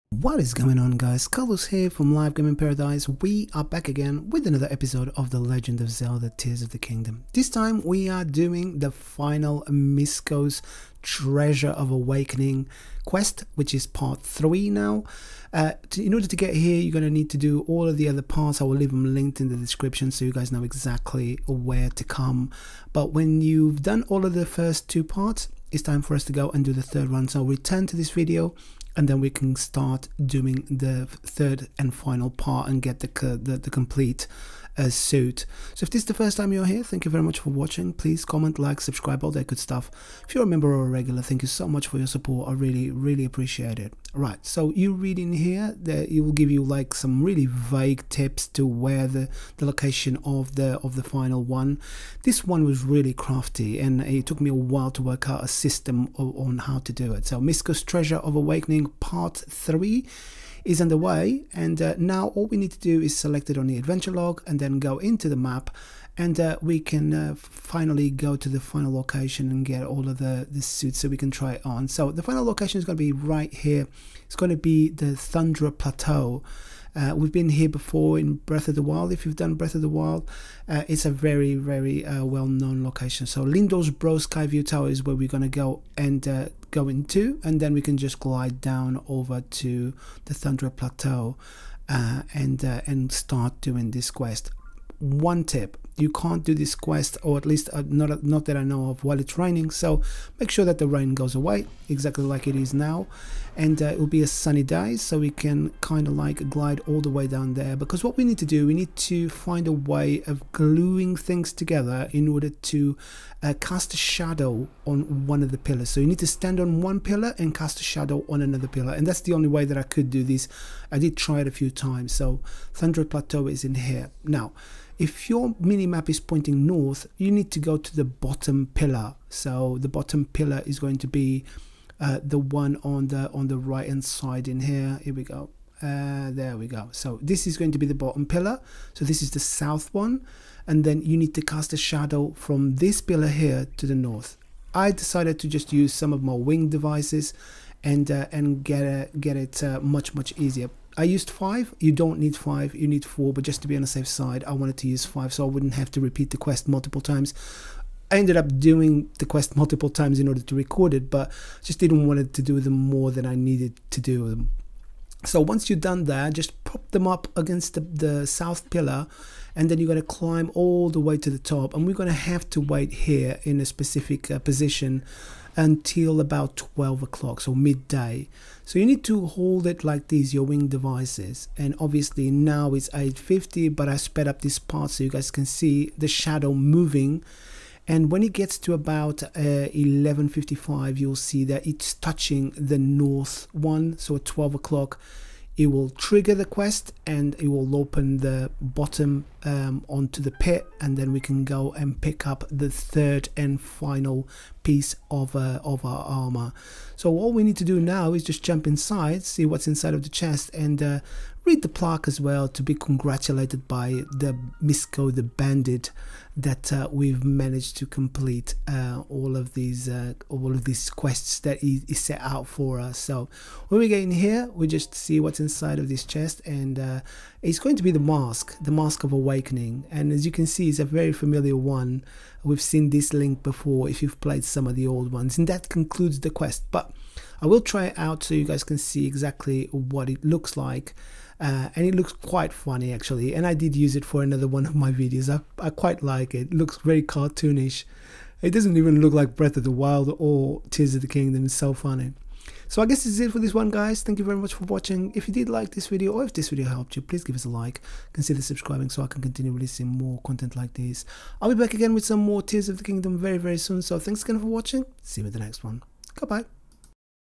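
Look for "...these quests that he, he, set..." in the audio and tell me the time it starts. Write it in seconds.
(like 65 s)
220 s.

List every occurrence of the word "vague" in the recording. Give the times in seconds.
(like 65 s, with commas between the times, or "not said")
47 s.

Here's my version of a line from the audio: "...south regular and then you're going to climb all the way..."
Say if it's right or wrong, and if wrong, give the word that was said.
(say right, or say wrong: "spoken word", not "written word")
wrong: "pillar", not "regular".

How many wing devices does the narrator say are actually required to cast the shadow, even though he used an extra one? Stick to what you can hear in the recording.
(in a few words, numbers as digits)
4.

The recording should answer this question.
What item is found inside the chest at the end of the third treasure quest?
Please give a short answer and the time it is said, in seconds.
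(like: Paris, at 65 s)
mask of awakening, at 228 s.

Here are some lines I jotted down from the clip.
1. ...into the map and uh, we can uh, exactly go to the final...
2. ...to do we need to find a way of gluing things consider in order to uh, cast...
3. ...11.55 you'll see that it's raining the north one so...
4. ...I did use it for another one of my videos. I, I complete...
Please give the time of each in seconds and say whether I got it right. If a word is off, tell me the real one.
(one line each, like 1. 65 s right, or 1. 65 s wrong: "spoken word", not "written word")
1. 64 s wrong: "finally", not "exactly"
2. 108 s wrong: "together", not "consider"
3. 189 s wrong: "touching", not "raining"
4. 243 s wrong: "quite", not "complete".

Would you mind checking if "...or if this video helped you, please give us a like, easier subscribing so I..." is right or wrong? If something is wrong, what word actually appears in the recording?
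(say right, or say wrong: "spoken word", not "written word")
wrong: "consider", not "easier".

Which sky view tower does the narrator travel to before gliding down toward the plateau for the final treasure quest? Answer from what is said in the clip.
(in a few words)
Lindor's Brow Sky View Tower.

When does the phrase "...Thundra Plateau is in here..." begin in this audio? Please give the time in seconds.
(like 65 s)
122 s.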